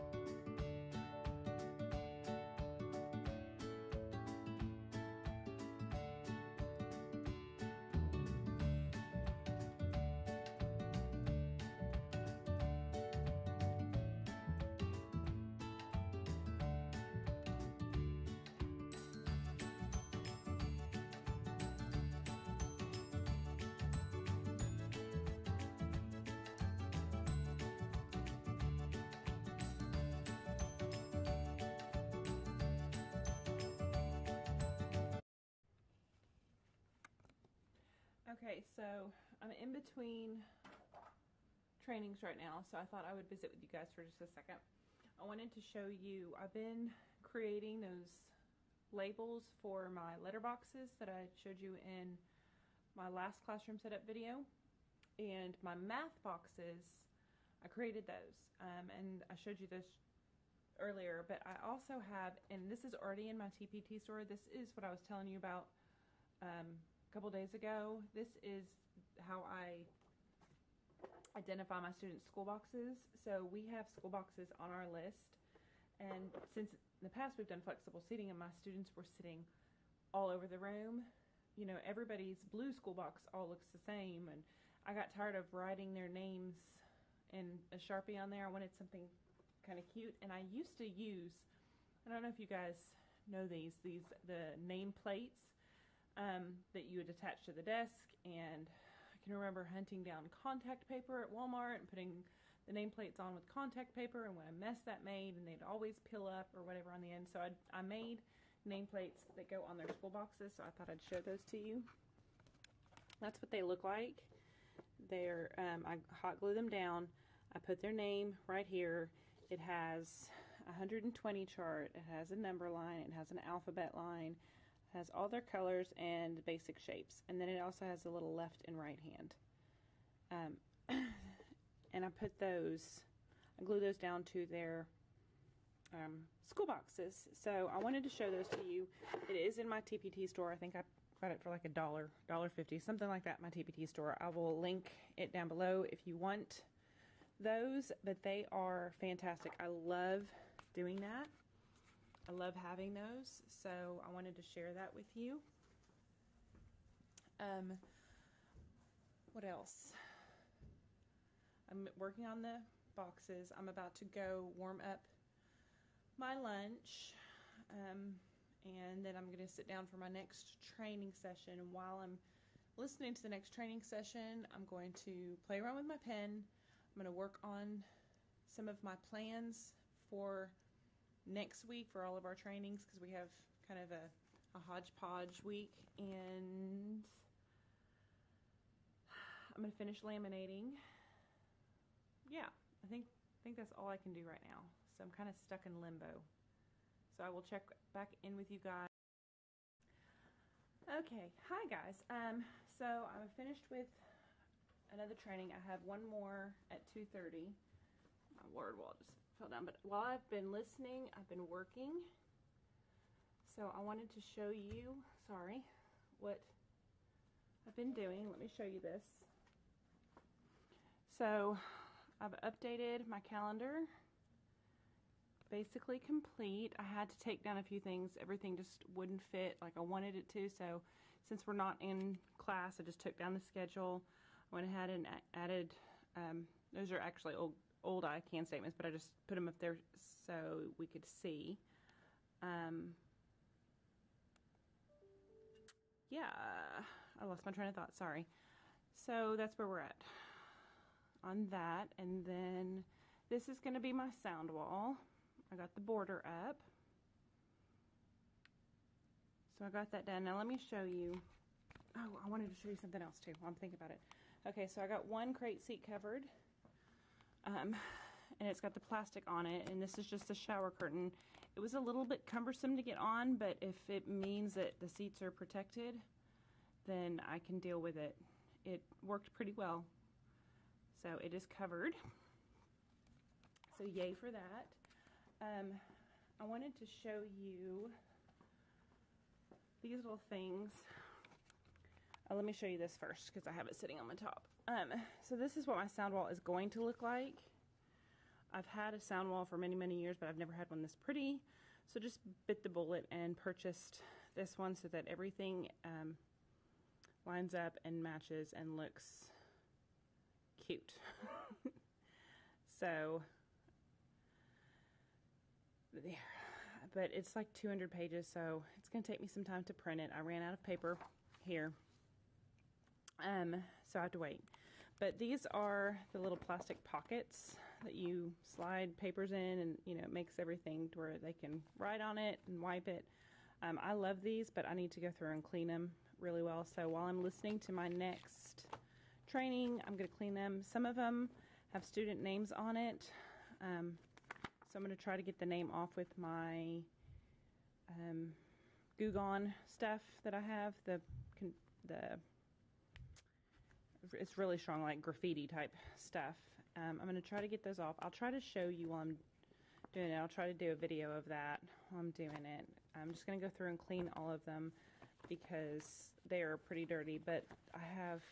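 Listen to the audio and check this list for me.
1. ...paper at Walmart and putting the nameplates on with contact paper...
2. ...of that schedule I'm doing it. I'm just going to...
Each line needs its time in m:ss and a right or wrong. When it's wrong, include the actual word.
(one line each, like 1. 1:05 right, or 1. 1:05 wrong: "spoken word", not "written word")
1. 1:40 right
2. 6:01 wrong: "while", not "schedule".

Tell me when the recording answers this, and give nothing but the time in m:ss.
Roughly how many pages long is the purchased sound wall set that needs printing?
5:17.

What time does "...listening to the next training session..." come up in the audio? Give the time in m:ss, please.
2:52.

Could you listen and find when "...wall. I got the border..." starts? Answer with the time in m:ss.
4:14.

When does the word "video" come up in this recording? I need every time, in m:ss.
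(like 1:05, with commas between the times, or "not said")
0:54, 6:00.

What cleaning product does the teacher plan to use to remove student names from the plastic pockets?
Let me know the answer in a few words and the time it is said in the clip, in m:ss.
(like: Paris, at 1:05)
Goo Gone, at 5:48.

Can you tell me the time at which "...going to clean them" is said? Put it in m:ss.
5:39.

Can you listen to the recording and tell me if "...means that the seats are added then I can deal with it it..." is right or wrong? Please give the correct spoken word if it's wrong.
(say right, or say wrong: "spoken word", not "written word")
wrong: "protected", not "added".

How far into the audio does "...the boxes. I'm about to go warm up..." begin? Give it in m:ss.
2:42.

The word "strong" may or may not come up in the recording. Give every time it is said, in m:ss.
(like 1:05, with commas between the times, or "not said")
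5:54.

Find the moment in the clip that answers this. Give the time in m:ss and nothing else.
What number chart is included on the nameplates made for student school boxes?
2:00.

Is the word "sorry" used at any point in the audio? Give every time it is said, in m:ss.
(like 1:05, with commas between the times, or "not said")
3:35, 4:07.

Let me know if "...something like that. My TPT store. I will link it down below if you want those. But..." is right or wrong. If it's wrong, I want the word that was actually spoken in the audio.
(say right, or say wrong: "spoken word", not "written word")
right.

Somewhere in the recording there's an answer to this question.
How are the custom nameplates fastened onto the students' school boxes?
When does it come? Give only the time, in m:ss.
1:56.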